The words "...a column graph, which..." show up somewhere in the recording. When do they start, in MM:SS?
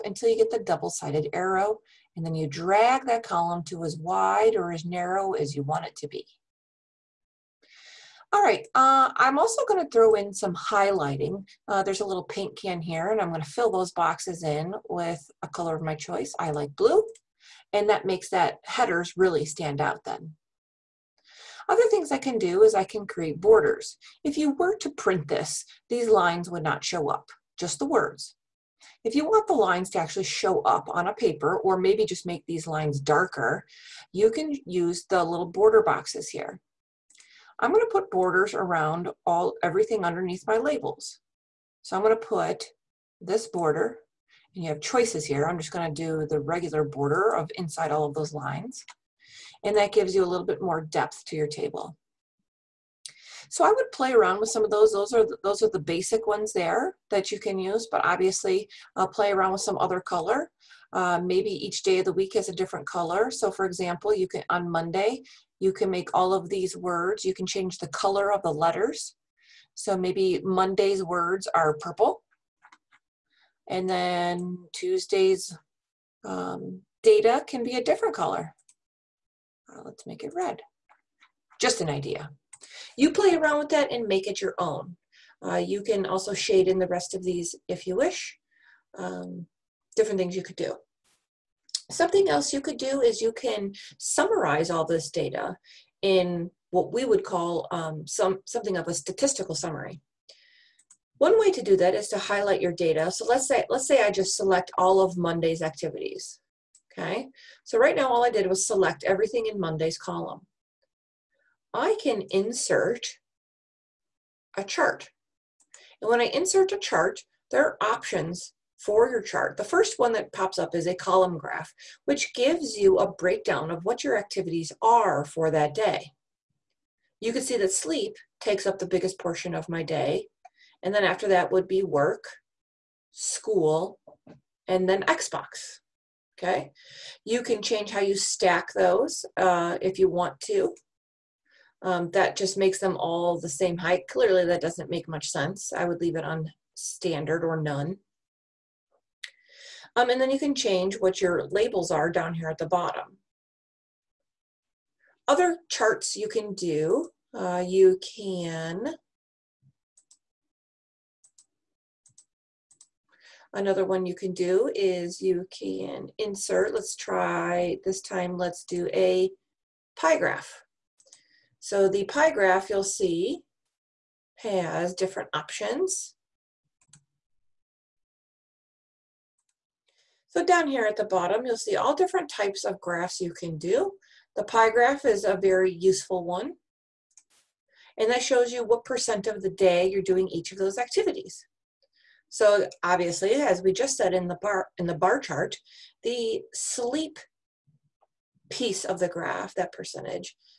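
02:00.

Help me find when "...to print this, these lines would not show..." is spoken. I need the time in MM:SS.
00:24.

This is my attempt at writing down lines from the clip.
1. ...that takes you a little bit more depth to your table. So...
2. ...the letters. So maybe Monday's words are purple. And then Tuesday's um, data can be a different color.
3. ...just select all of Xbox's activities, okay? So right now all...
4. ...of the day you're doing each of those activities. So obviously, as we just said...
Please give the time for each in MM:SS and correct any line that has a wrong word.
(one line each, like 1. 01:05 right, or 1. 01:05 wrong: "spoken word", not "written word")
1. 00:49 wrong: "gives", not "takes"
2. 01:08 right
3. 01:44 wrong: "Monday", not "Xbox"
4. 03:09 right.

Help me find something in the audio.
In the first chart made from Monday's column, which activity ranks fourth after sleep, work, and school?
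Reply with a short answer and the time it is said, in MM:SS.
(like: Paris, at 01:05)
Xbox, at 02:15.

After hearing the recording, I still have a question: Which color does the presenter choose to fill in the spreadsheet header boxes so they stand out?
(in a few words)
Blue.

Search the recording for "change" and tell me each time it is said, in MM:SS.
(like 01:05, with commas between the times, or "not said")
01:07, 02:17, 02:30.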